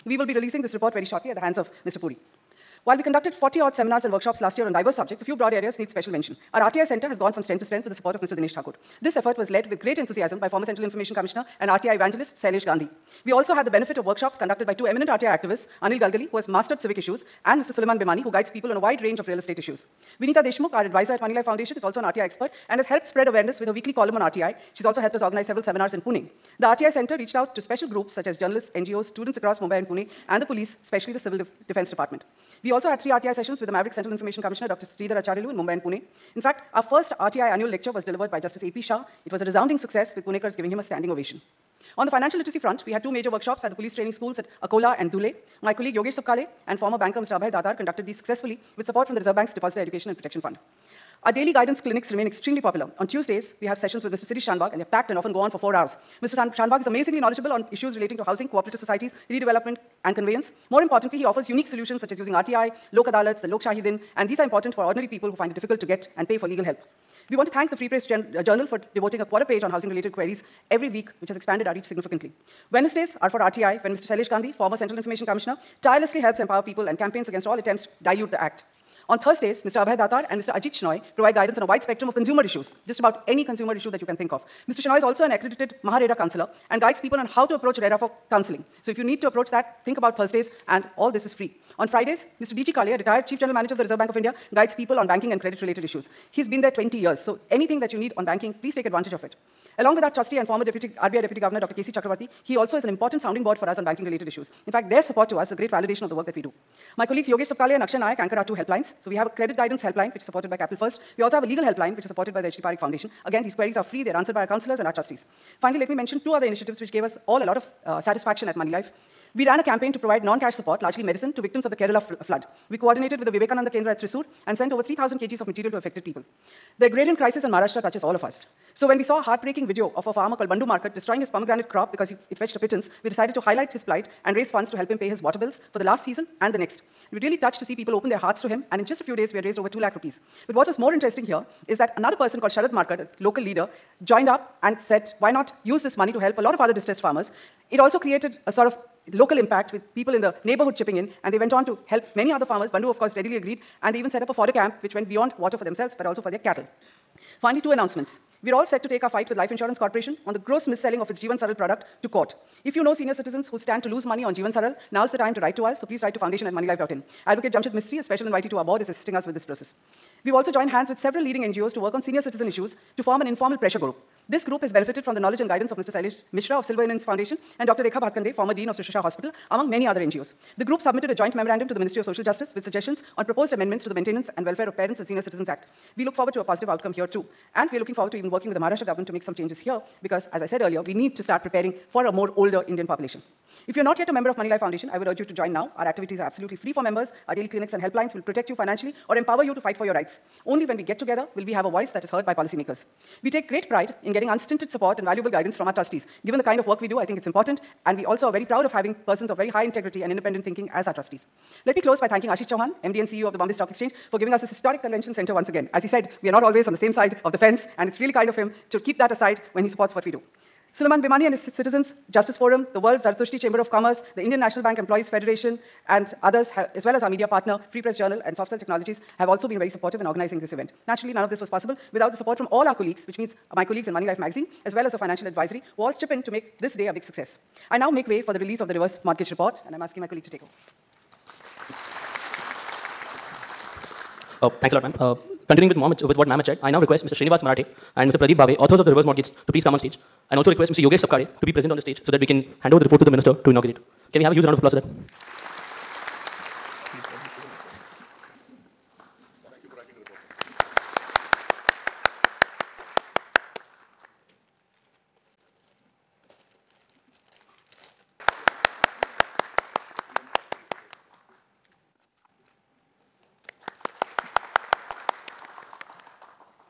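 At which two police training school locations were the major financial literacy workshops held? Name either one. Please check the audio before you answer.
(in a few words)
Akola.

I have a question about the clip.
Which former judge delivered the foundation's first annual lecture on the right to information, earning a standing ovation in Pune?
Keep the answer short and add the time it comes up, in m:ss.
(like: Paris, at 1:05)
Justice A.P. Shah, at 0:38.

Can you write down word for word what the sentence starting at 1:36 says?
He's been there 20 years, so anything that you need on banking, please take advantage of it.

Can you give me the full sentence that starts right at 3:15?
Our activities are absolutely free for members.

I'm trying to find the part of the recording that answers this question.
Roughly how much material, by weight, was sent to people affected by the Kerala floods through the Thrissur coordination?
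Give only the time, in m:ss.
2:04.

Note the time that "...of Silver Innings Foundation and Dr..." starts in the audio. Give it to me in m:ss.
2:56.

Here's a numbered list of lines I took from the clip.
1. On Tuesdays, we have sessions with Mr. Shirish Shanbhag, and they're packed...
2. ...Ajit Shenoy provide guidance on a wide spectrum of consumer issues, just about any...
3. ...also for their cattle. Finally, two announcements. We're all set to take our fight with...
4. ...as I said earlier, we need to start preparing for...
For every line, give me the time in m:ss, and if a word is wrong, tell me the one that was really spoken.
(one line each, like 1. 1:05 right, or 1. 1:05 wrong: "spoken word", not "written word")
1. 0:52 right
2. 1:20 right
3. 2:36 right
4. 3:10 right.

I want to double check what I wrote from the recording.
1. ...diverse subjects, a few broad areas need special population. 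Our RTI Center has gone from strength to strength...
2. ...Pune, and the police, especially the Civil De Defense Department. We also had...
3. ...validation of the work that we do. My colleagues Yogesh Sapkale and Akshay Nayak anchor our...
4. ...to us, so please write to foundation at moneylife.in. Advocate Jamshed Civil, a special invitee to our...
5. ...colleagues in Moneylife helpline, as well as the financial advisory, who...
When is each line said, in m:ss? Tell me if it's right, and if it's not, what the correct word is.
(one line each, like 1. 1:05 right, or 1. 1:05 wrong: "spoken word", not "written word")
1. 0:04 wrong: "mention", not "population"
2. 0:29 right
3. 1:45 right
4. 2:45 wrong: "Mistry", not "Civil"
5. 3:53 wrong: "magazine", not "helpline".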